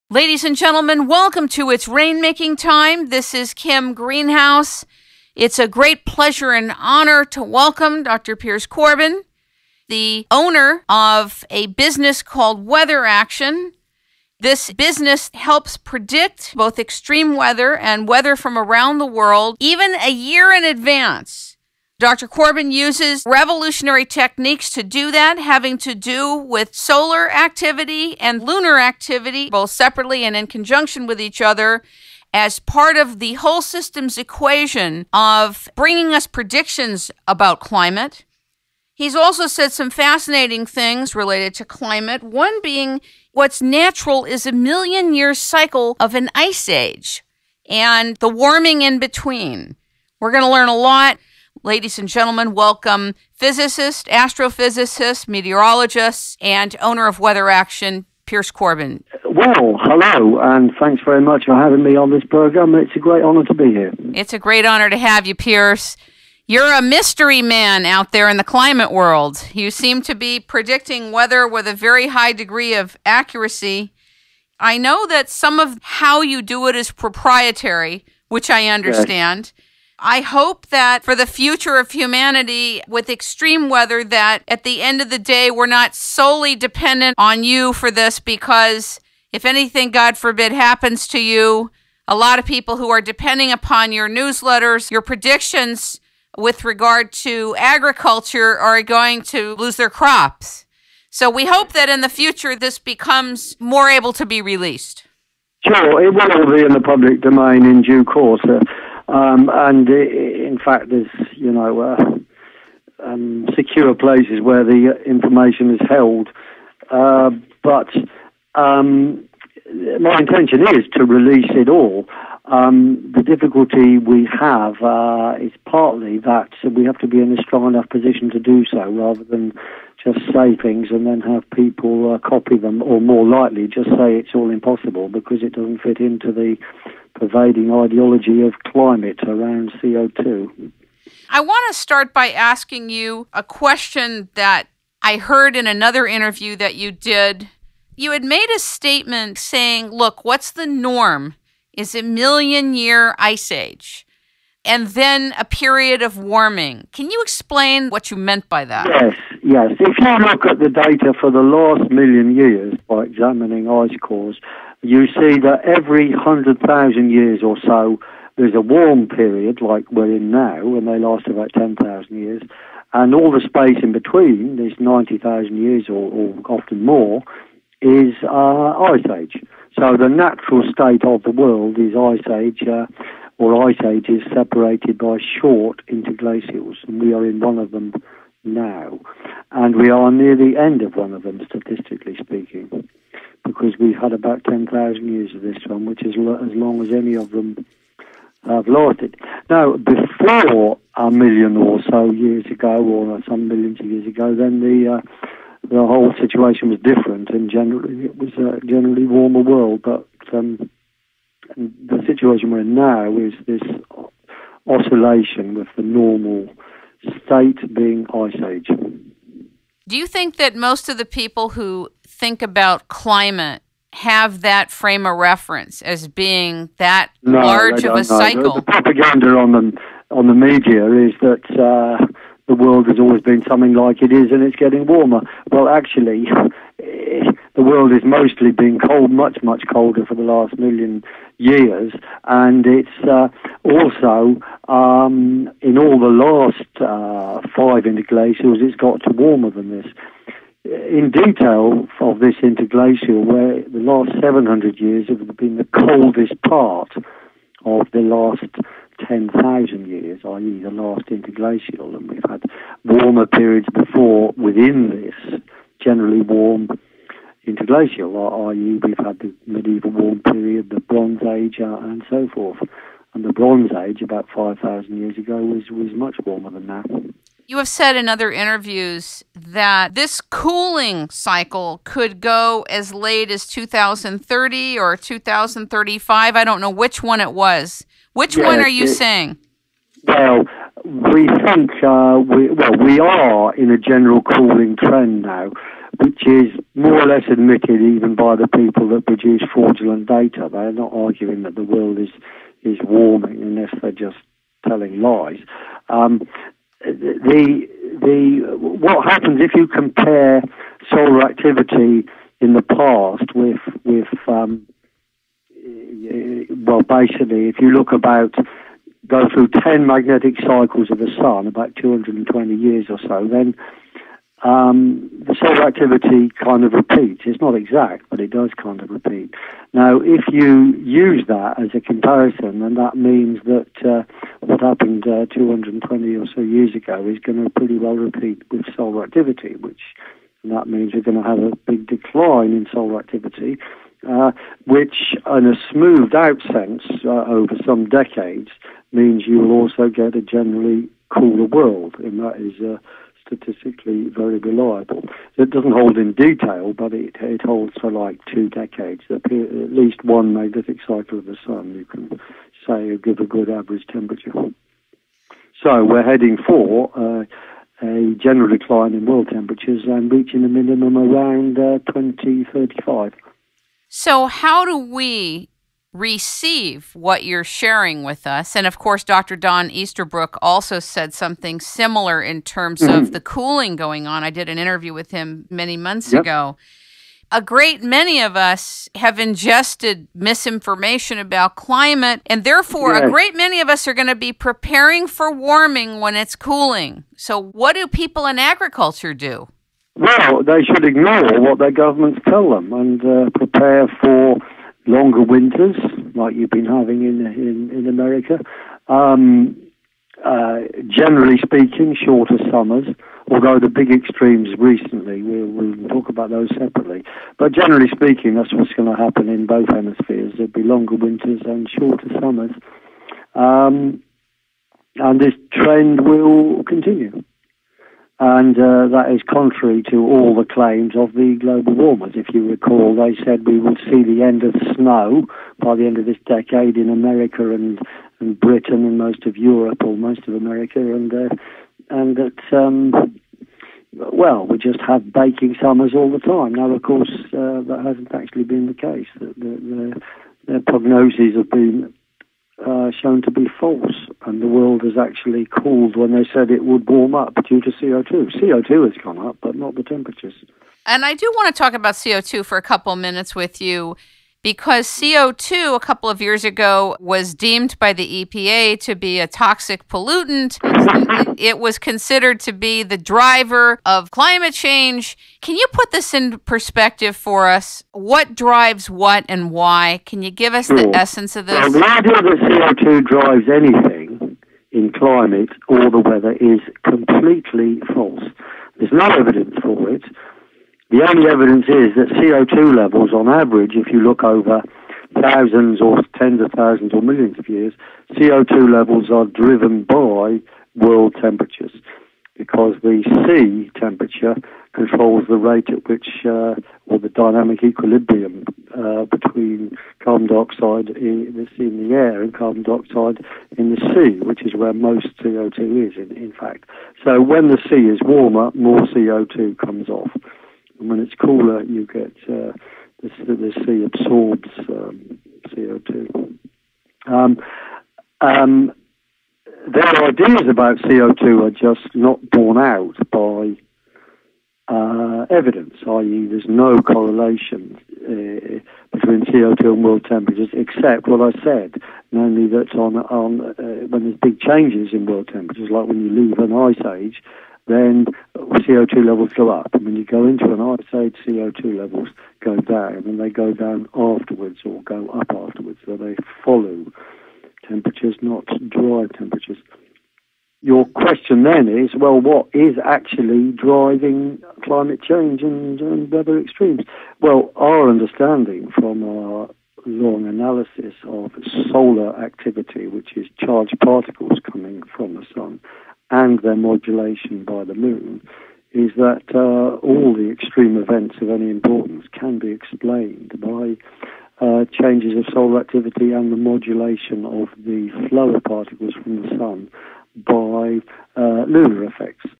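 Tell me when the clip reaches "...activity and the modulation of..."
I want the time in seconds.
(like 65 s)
585 s.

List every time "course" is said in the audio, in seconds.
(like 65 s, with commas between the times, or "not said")
108 s, 378 s, 446 s.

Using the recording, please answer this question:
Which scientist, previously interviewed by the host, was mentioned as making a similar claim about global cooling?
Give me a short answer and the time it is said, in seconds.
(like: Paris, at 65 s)
Don Easterbrook, at 379 s.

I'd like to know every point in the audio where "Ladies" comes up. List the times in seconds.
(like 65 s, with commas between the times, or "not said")
0 s, 51 s.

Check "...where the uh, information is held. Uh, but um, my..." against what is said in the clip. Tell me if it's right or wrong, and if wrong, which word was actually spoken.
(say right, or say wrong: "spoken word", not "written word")
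right.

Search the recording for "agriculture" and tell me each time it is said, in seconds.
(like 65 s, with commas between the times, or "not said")
97 s, 398 s.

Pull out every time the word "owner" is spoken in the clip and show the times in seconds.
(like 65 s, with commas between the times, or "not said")
10 s, 56 s.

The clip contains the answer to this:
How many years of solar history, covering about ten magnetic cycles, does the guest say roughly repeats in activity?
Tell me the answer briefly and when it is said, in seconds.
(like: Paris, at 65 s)
220 years, at 321 s.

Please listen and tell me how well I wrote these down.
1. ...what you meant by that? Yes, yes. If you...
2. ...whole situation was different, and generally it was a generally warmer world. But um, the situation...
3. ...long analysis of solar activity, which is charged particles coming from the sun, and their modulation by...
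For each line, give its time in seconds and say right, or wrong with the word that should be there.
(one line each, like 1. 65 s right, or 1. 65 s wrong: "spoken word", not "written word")
1. 157 s right
2. 205 s right
3. 569 s right.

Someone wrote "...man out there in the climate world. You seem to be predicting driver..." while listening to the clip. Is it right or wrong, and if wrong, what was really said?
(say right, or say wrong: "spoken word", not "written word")
wrong: "weather", not "driver".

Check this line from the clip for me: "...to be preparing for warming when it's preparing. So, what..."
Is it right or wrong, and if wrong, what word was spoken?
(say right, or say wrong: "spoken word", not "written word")
wrong: "cooling", not "preparing".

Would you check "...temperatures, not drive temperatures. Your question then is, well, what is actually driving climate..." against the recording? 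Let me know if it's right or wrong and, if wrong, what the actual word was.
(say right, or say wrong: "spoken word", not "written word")
right.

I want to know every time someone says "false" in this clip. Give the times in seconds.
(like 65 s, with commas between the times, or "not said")
453 s, 487 s.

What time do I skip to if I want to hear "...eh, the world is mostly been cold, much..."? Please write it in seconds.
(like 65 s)
236 s.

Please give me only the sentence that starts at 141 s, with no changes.
I want to start by asking you a question that I heard in another interview that you did.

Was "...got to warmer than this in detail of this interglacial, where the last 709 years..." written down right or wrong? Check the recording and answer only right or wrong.
wrong.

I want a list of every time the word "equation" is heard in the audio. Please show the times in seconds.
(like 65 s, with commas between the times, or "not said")
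34 s.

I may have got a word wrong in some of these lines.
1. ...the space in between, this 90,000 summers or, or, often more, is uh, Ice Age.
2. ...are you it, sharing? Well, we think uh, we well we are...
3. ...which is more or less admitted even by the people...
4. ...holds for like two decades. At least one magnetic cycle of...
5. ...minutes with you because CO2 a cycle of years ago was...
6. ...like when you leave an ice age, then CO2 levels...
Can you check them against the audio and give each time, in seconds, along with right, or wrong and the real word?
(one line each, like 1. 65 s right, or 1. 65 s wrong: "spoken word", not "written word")
1. 173 s wrong: "years", not "summers"
2. 288 s wrong: "saying", not "sharing"
3. 296 s right
4. 357 s right
5. 462 s wrong: "couple", not "cycle"
6. 545 s right.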